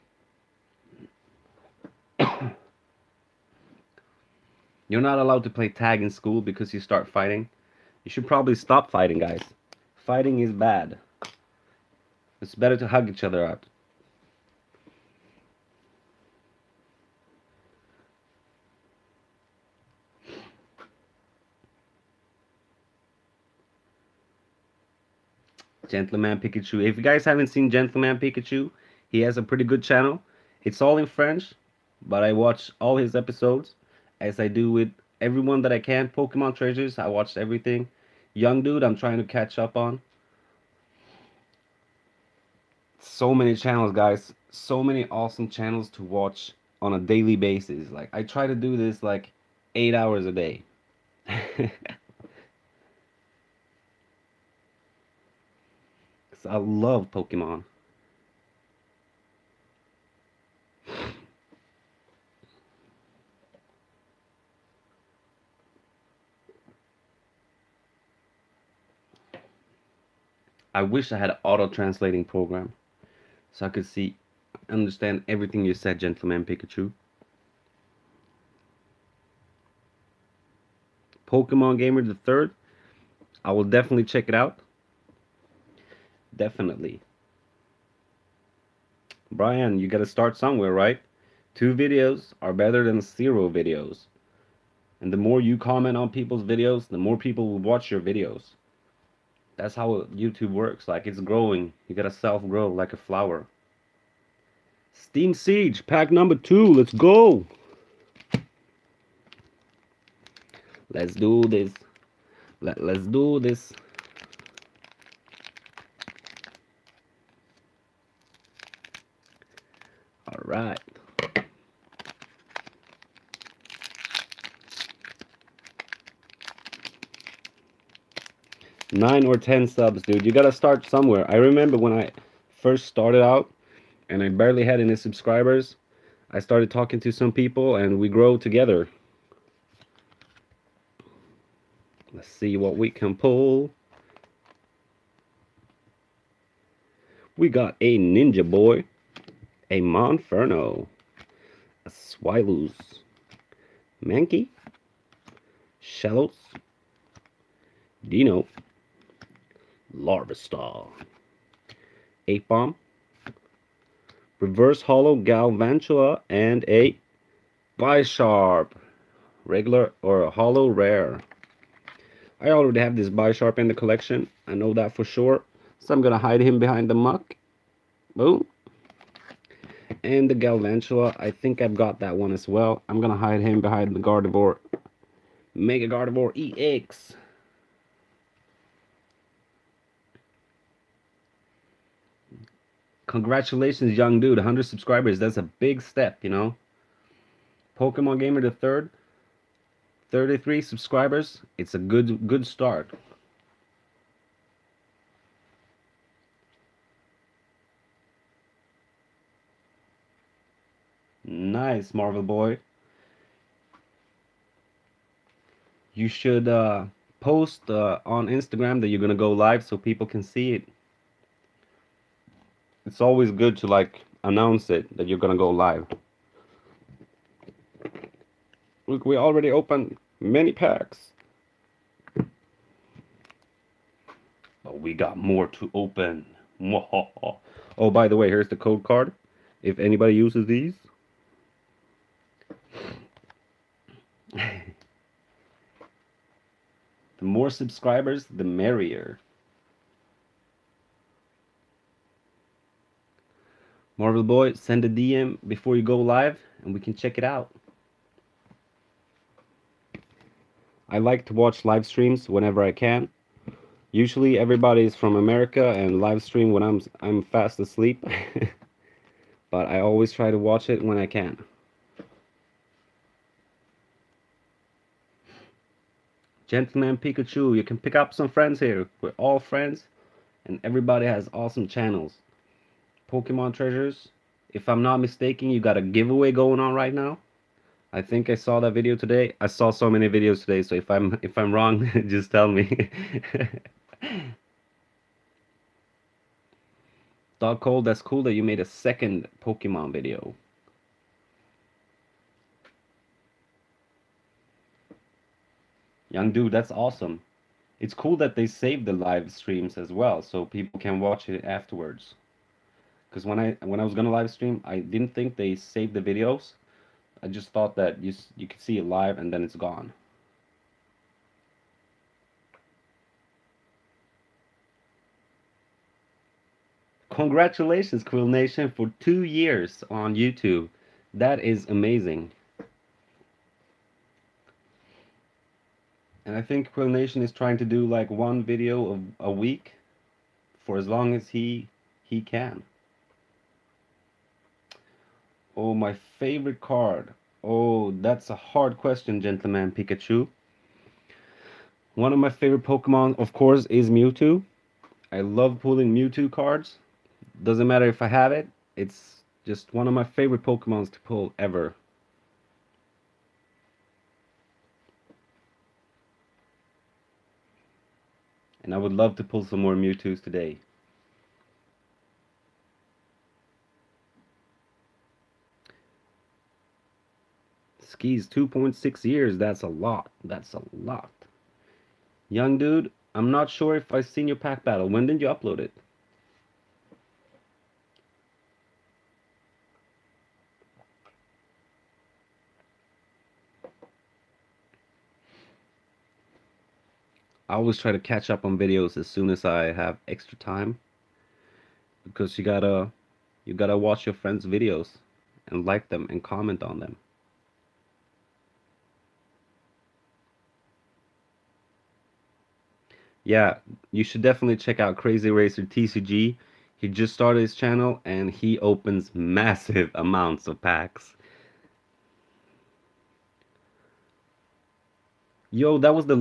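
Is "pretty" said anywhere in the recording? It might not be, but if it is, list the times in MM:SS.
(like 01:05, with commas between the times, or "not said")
00:29.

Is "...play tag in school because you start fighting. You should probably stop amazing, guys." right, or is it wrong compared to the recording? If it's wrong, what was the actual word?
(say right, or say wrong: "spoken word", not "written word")
wrong: "fighting", not "amazing".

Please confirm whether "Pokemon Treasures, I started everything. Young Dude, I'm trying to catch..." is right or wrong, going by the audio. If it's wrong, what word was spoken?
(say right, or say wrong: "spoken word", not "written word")
wrong: "watched", not "started".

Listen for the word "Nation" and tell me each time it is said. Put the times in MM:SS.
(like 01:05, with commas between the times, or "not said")
05:28, 05:36.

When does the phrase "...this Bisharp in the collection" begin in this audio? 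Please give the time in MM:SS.
02:52.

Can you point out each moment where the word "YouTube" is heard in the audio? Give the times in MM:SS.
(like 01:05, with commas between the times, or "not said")
01:40, 05:30.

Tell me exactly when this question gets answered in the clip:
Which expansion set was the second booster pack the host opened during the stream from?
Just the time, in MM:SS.
01:44.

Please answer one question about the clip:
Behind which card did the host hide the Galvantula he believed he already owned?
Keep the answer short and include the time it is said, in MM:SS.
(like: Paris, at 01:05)
Mega Gardevoir EX, at 03:05.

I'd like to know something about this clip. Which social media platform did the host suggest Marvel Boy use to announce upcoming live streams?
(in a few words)
Instagram.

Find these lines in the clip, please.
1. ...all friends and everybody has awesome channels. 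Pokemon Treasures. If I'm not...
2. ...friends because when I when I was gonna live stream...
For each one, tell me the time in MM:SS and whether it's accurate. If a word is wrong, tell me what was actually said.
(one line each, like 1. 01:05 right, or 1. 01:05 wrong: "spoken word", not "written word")
1. 04:39 right
2. 05:11 wrong: "afterwards", not "friends".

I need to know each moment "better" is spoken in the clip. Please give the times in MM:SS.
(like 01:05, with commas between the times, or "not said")
00:12, 01:32.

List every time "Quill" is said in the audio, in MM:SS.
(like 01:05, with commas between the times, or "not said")
05:28, 05:36.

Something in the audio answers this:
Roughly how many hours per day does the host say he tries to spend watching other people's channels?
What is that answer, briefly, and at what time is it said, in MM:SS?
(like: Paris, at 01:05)
8, at 00:49.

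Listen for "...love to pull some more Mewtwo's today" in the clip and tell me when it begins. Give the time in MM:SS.
06:08.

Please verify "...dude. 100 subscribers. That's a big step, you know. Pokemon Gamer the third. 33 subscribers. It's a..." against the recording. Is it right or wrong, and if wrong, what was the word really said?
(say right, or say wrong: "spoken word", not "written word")
right.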